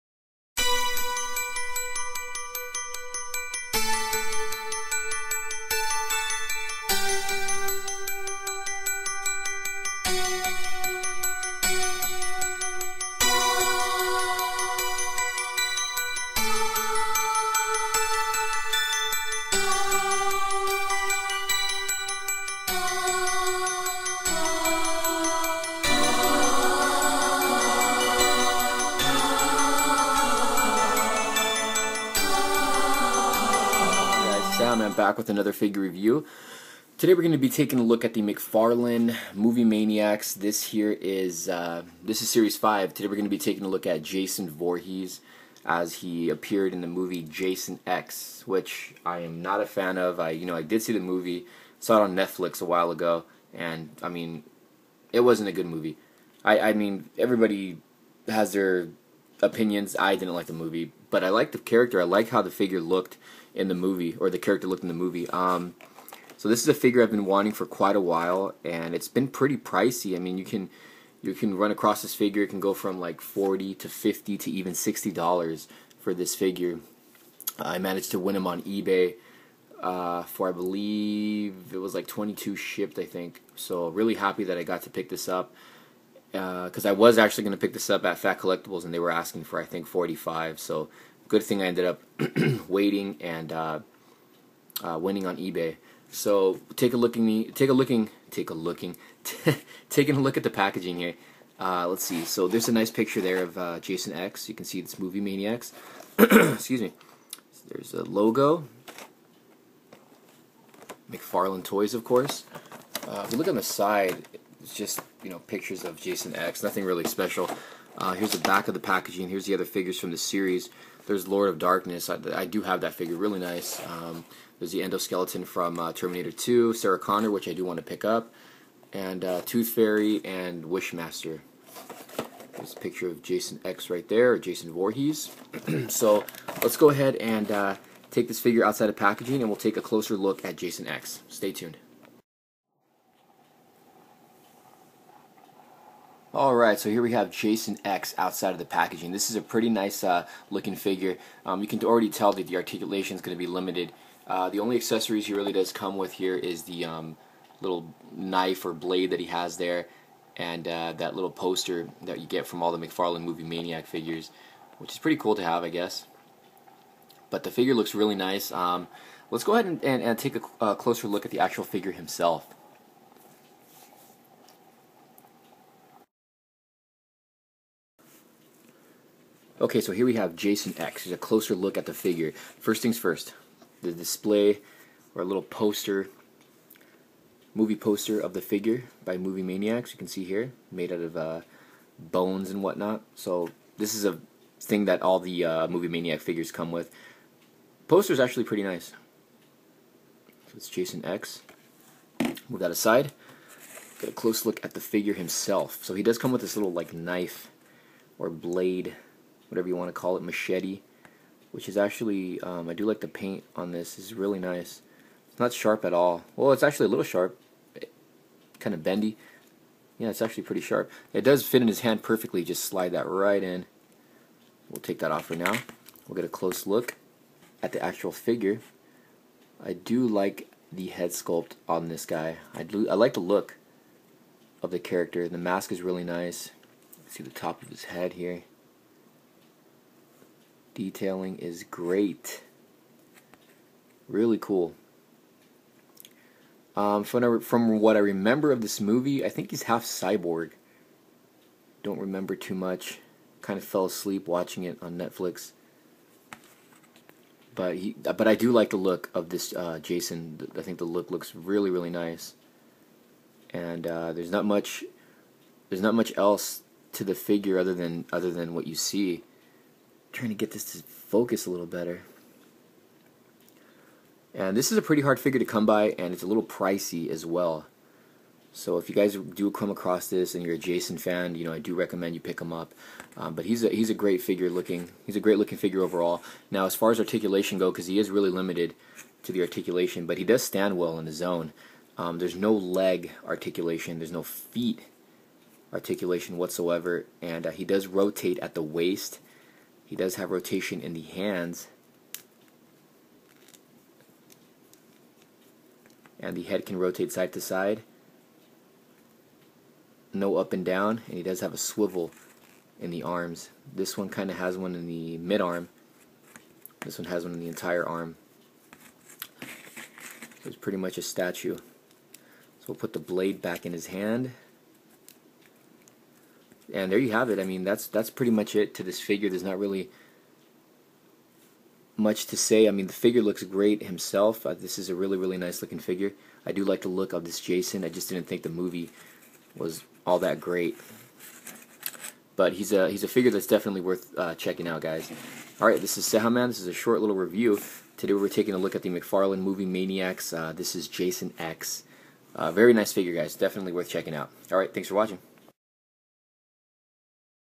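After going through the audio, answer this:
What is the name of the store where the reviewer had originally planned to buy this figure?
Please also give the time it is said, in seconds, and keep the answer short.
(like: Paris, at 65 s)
Fat Collectibles, at 88 s.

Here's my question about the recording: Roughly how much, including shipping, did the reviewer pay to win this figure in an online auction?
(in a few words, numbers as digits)
$22.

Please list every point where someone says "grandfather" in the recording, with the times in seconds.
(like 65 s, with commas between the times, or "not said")
not said.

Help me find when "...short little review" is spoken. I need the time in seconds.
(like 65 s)
346 s.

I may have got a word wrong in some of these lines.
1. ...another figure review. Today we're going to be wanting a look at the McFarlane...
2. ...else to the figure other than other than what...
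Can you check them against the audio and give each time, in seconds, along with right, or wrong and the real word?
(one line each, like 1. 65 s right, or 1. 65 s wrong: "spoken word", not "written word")
1. 35 s wrong: "taking", not "wanting"
2. 266 s right.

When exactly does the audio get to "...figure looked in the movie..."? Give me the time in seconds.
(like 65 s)
62 s.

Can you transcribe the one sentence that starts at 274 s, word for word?
And this is a pretty hard figure to come by, and it's a little pricey as well.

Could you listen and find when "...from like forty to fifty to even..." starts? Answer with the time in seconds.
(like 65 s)
72 s.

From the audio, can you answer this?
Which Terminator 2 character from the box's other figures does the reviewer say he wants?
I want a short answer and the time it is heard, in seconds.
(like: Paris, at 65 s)
Sarah Connor, at 126 s.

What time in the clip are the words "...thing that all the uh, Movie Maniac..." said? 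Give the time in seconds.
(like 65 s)
194 s.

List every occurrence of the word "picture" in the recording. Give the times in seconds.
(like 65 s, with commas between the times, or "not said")
102 s, 115 s, 132 s.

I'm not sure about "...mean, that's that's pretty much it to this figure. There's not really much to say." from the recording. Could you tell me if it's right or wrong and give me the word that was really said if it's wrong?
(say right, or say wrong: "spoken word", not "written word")
right.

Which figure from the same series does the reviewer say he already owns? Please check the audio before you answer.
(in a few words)
Lord of Darkness.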